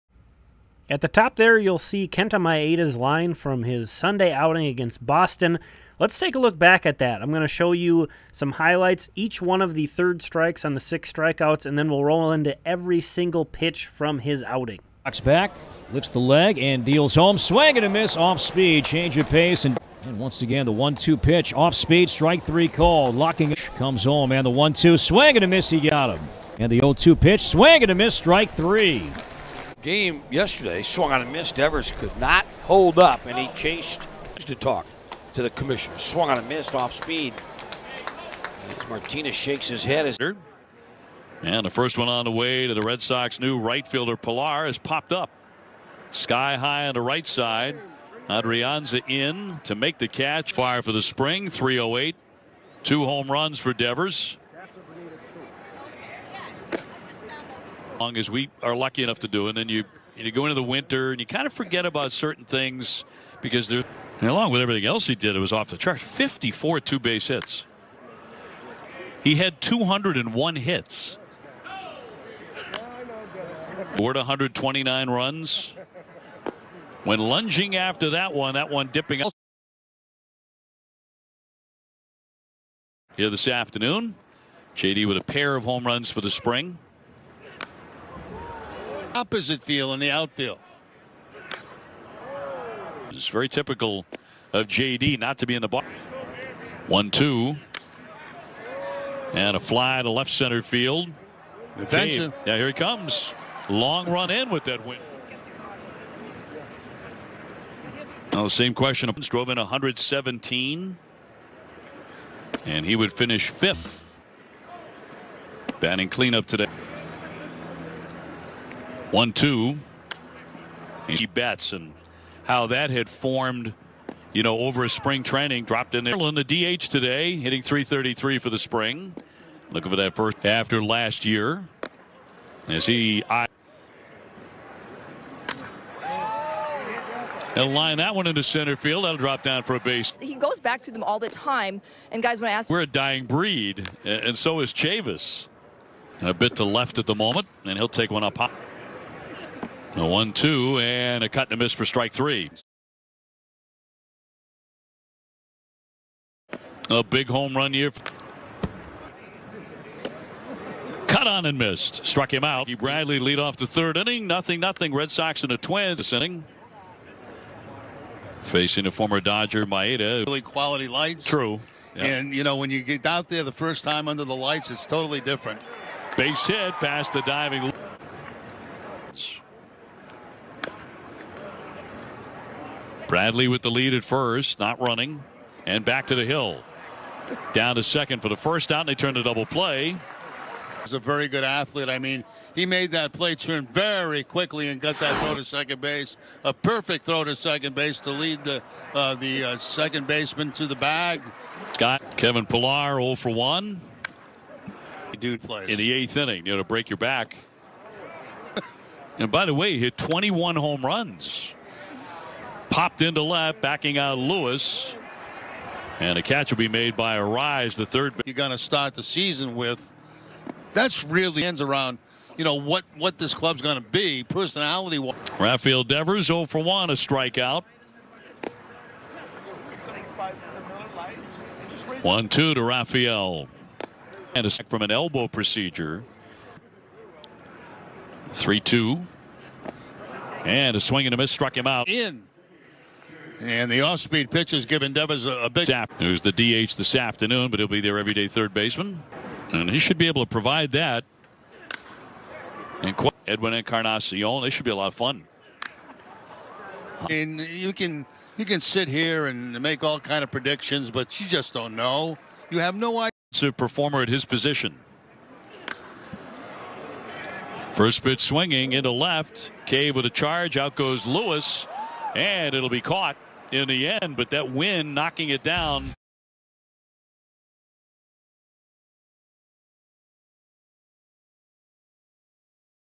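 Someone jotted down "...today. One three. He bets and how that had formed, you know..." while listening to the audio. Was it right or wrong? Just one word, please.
wrong.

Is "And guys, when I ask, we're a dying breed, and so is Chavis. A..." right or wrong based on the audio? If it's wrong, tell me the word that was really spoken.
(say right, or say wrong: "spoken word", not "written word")
right.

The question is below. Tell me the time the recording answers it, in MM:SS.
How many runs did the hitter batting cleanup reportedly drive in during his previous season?
01:49.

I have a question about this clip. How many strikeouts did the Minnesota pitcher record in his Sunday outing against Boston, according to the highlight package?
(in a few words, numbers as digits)
6.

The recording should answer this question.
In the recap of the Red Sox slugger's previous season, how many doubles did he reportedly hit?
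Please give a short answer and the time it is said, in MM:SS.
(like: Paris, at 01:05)
54, at 01:06.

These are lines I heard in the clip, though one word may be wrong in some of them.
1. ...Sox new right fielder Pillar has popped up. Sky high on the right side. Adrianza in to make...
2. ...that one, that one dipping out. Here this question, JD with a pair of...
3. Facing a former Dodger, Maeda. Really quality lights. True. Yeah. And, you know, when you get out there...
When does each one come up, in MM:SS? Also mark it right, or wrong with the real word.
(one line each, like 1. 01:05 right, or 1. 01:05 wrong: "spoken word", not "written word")
1. 00:43 right
2. 01:18 wrong: "afternoon", not "question"
3. 02:48 right.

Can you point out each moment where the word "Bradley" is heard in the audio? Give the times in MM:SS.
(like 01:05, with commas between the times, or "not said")
02:42, 03:03.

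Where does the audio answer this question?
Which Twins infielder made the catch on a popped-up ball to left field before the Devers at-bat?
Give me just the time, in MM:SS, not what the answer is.
03:37.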